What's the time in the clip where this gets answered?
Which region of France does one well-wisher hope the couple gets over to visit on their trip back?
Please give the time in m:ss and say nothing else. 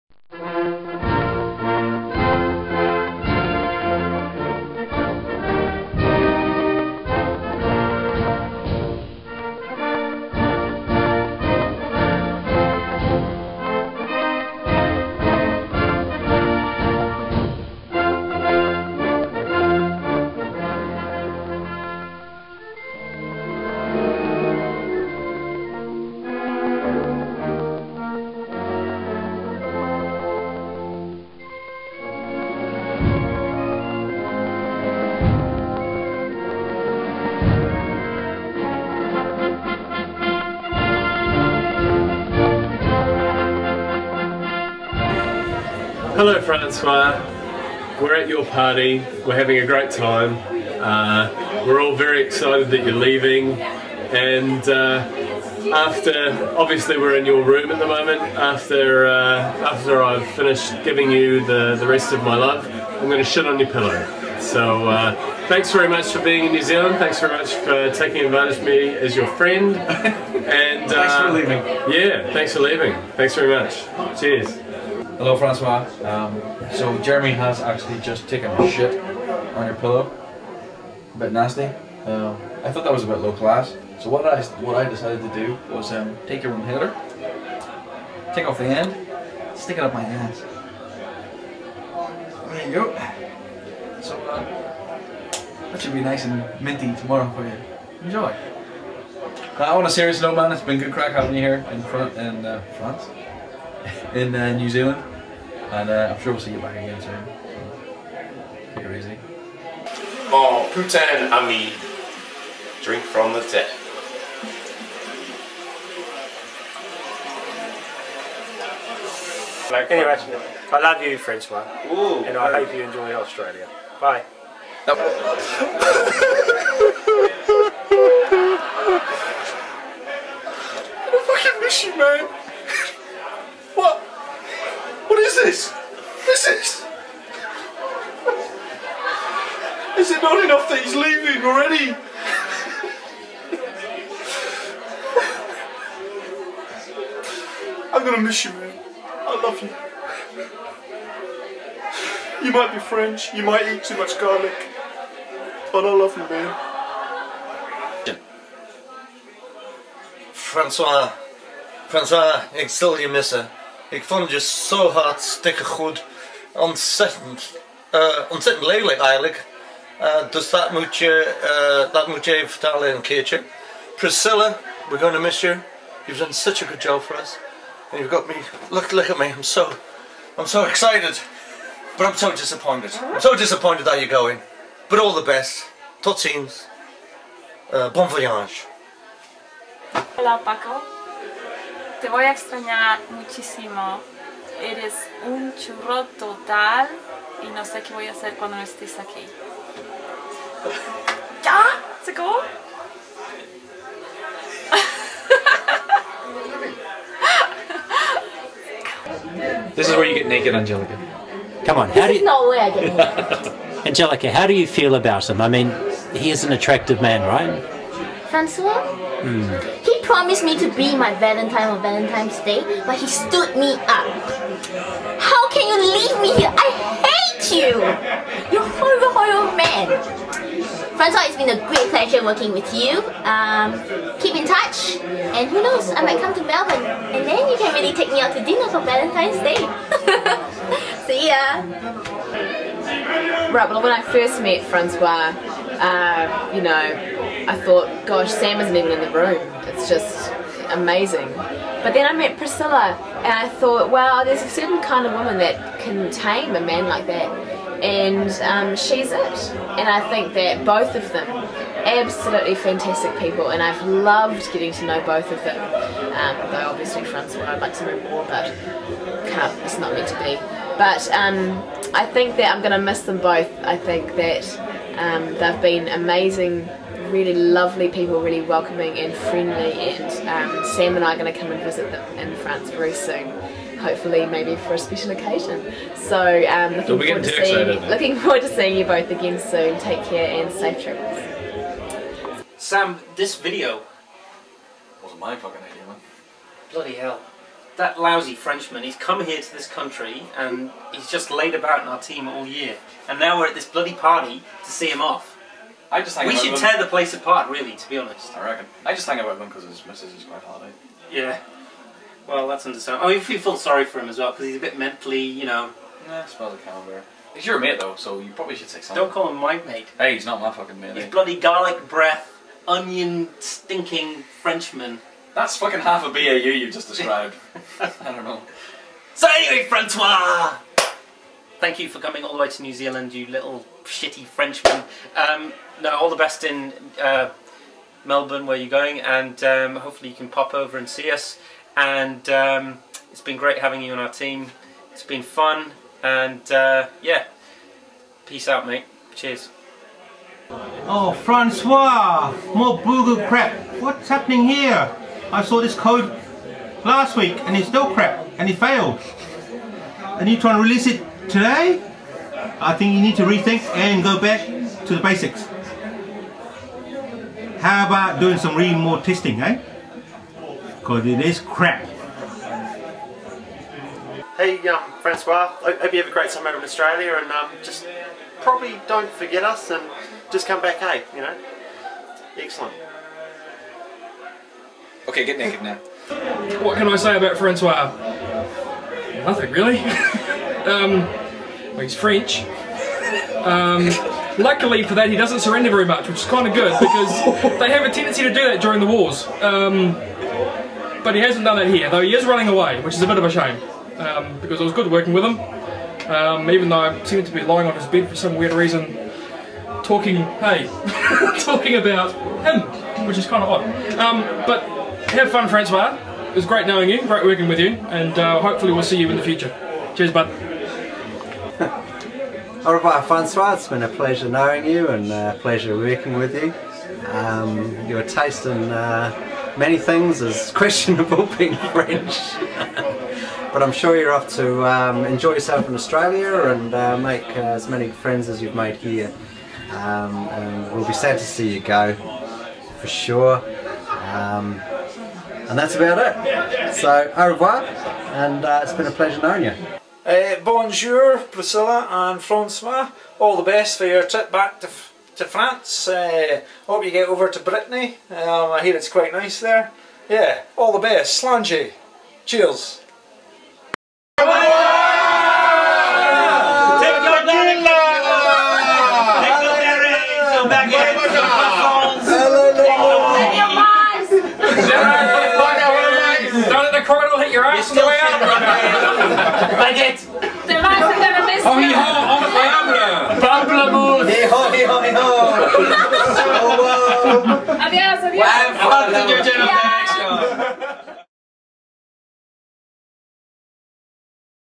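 7:37.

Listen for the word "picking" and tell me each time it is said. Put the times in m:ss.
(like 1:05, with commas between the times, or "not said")
not said.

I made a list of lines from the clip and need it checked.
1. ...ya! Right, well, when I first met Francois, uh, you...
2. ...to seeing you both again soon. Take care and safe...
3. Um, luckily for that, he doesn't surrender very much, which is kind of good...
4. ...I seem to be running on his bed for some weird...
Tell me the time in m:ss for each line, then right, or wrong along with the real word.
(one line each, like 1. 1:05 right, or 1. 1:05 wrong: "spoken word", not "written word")
1. 4:01 right
2. 4:48 right
3. 6:33 right
4. 6:46 wrong: "lying", not "running".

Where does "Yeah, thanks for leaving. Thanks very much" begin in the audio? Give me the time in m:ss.
1:11.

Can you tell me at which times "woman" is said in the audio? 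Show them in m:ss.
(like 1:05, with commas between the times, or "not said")
4:15.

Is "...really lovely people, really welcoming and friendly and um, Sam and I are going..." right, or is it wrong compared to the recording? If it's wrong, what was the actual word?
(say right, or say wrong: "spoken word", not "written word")
right.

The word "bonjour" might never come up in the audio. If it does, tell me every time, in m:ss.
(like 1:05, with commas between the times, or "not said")
7:30.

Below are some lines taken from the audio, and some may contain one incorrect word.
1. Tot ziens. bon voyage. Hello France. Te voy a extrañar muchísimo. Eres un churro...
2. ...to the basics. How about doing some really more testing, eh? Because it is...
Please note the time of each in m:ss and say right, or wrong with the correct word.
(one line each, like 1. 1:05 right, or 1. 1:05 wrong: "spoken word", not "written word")
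1. 3:06 wrong: "Paco", not "France"
2. 6:04 right.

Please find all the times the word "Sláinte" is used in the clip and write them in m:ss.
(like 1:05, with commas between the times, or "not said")
7:41.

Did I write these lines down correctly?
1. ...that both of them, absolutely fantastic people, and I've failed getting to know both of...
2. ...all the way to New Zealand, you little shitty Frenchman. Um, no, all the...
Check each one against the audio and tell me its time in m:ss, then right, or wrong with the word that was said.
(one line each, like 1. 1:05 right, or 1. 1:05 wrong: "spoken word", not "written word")
1. 4:20 wrong: "loved", not "failed"
2. 5:32 right.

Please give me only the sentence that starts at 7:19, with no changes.
Um, and we'll be sad to see you go, for sure.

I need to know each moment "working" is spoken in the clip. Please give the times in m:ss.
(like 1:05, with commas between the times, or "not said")
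3:52, 6:44, 6:57, 7:05.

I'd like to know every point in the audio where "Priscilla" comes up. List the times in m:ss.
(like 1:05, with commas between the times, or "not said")
2:53, 4:12, 7:31.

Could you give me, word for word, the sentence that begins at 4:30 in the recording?
But um, I think that I'm going to miss them both.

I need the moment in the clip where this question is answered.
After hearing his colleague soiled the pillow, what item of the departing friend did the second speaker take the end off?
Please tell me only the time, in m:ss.
1:26.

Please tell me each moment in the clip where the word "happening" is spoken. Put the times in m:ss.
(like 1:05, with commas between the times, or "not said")
5:54.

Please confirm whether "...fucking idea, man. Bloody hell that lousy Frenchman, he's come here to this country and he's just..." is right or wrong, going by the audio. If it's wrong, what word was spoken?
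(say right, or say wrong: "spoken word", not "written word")
right.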